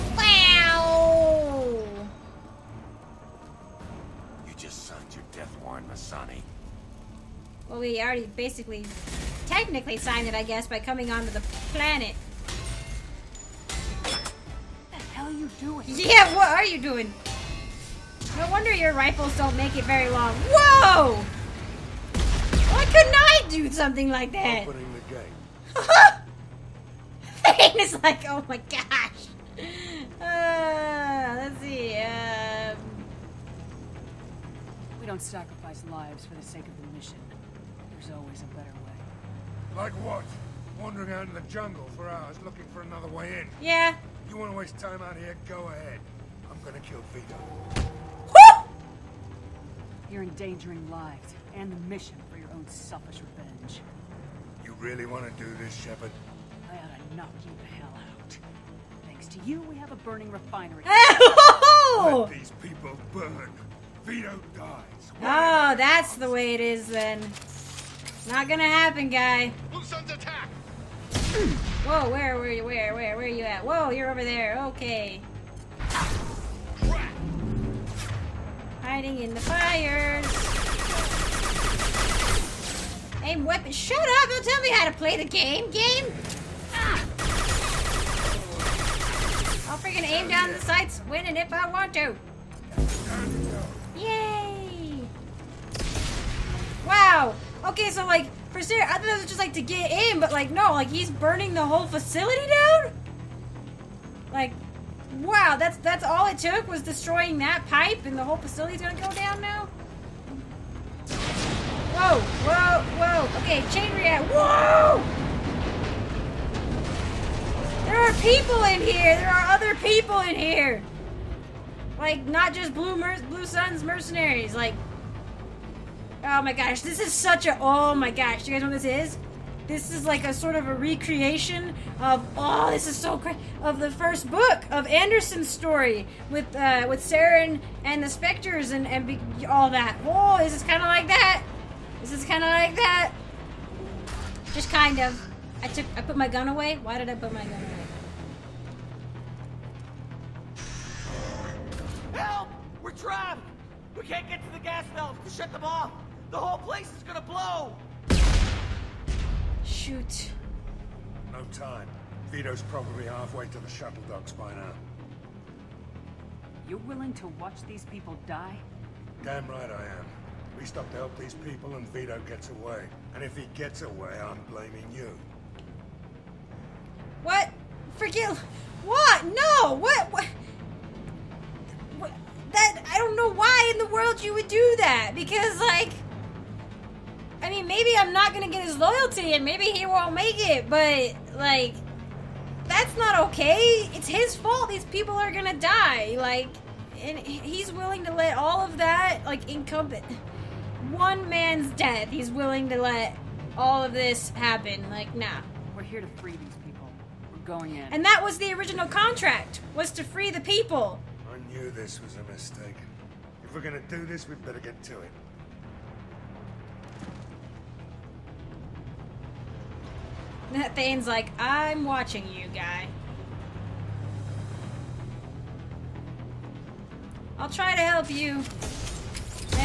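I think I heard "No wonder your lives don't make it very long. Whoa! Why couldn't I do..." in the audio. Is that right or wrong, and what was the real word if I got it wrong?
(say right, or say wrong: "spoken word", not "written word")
wrong: "rifles", not "lives".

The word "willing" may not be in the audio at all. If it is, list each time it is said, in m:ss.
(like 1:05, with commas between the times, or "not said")
2:46, 3:17, 3:22.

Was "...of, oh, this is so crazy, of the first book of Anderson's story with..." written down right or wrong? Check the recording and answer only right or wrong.
right.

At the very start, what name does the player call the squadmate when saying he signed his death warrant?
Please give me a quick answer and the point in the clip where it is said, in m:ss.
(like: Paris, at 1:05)
Massani, at 0:05.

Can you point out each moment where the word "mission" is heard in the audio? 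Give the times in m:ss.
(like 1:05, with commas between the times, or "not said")
0:36, 0:51.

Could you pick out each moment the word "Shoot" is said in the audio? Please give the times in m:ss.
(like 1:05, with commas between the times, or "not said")
2:39.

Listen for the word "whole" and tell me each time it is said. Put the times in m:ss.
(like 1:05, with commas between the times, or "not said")
1:41, 1:48, 2:36.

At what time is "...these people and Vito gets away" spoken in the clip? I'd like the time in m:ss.
2:51.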